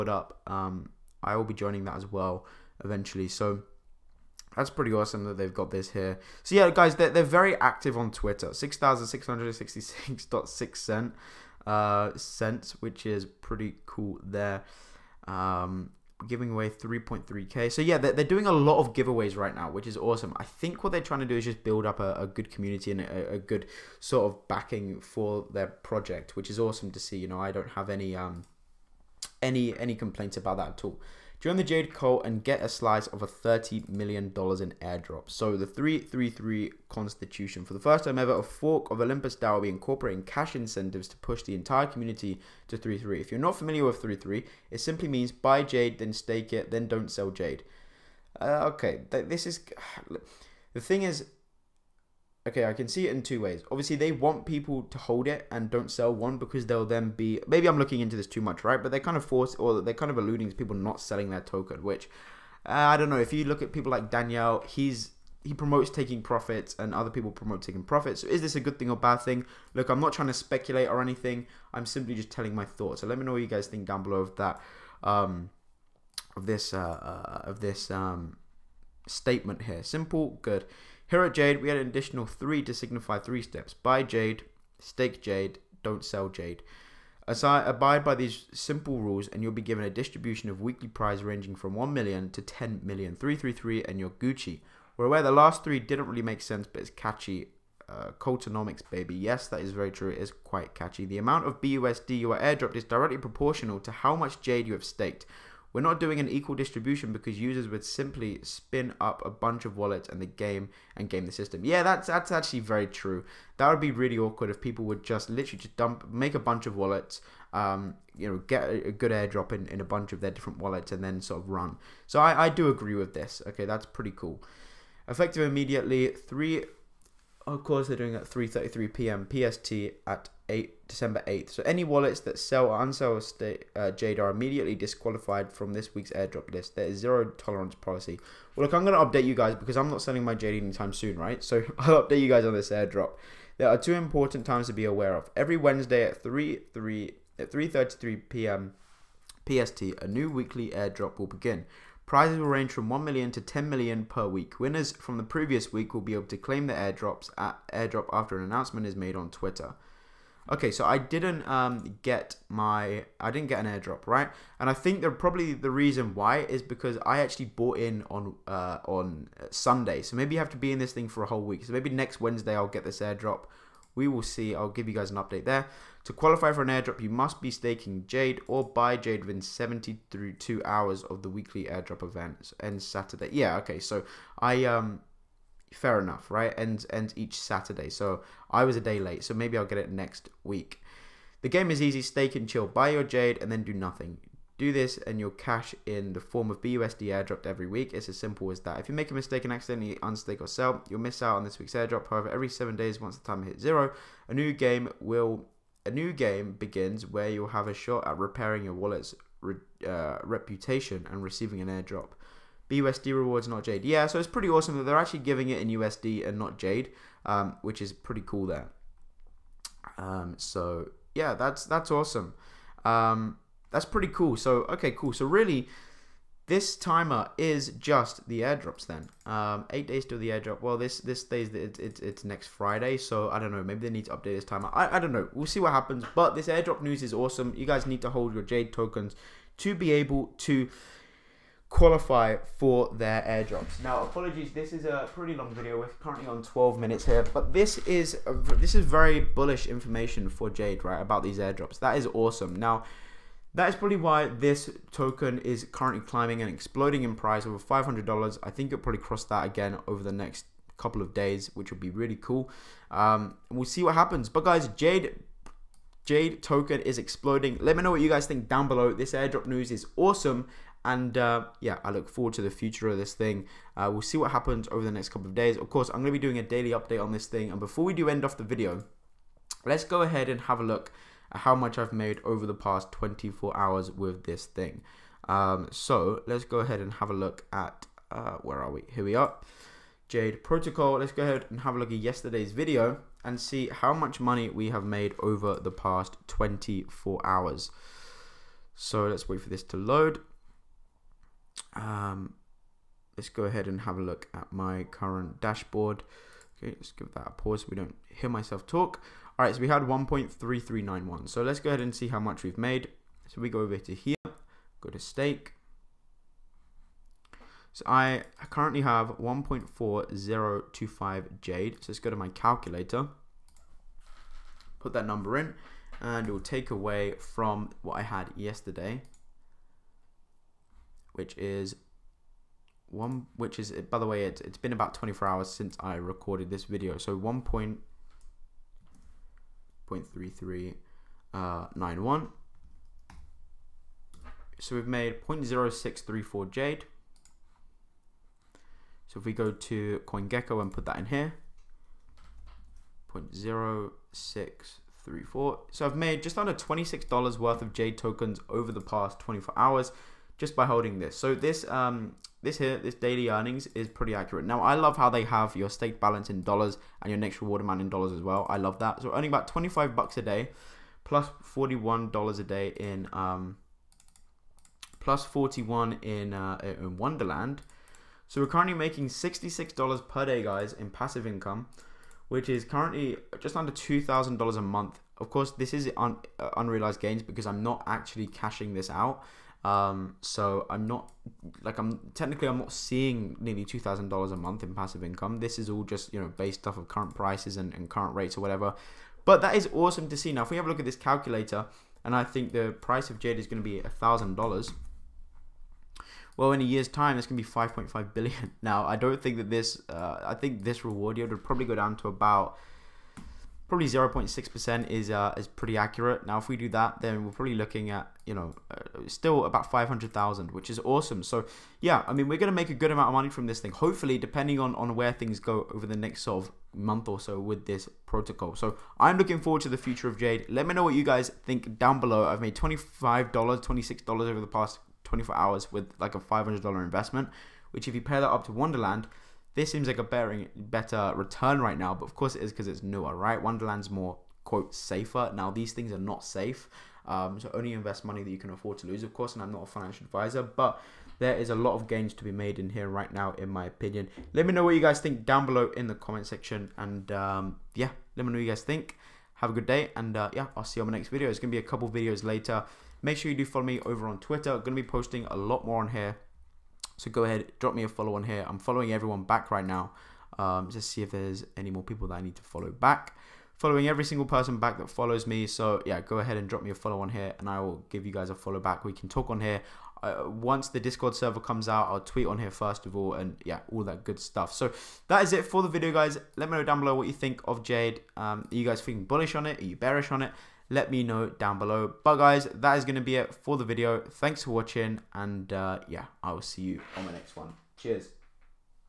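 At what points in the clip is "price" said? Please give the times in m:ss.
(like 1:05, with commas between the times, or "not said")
4:17, 6:37, 6:42.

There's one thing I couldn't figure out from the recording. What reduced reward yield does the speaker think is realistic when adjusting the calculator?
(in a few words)
0.6%.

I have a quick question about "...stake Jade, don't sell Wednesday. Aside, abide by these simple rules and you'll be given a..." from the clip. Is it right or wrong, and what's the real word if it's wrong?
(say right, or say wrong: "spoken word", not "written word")
wrong: "Jade", not "Wednesday".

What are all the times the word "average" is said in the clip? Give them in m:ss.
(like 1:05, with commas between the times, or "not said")
not said.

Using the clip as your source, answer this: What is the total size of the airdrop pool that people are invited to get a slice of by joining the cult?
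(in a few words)
$30 million.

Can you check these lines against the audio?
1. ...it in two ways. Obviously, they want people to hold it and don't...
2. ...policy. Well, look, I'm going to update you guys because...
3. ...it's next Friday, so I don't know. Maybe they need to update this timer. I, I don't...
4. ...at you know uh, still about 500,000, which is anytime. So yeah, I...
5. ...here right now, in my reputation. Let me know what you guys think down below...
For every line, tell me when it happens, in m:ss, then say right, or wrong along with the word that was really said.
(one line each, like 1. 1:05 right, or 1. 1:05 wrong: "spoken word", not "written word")
1. 0:53 right
2. 2:17 right
3. 3:52 right
4. 6:57 wrong: "awesome", not "anytime"
5. 7:32 wrong: "opinion", not "reputation".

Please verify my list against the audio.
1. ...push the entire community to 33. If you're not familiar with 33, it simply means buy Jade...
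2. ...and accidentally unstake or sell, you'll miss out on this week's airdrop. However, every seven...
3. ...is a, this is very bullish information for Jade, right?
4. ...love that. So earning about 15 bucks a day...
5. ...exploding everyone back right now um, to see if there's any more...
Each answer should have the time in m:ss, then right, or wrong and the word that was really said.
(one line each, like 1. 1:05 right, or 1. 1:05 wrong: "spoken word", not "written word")
1. 0:41 right
2. 3:19 right
3. 4:07 right
4. 6:08 wrong: "25", not "15"
5. 7:48 wrong: "following", not "exploding".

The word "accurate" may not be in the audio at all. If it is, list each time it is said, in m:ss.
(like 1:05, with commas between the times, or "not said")
6:04, 6:55.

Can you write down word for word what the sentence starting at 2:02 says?
So I, I do agree with this.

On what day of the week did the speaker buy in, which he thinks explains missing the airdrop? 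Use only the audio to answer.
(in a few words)
Sunday.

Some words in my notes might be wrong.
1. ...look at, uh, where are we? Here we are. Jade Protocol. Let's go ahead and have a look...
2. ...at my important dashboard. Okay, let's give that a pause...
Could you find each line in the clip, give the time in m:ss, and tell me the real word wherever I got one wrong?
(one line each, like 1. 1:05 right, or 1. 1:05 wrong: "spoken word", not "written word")
1. 4:47 right
2. 5:04 wrong: "current", not "important".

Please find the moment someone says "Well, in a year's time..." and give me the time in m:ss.
6:46.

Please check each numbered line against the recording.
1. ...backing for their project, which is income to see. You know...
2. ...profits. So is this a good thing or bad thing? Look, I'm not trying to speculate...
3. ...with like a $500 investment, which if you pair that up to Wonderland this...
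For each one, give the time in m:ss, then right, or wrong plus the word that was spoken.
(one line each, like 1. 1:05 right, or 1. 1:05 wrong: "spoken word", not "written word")
1. 0:24 wrong: "awesome", not "income"
2. 1:07 right
3. 7:15 right.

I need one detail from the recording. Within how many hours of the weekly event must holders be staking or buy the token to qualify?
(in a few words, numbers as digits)
72.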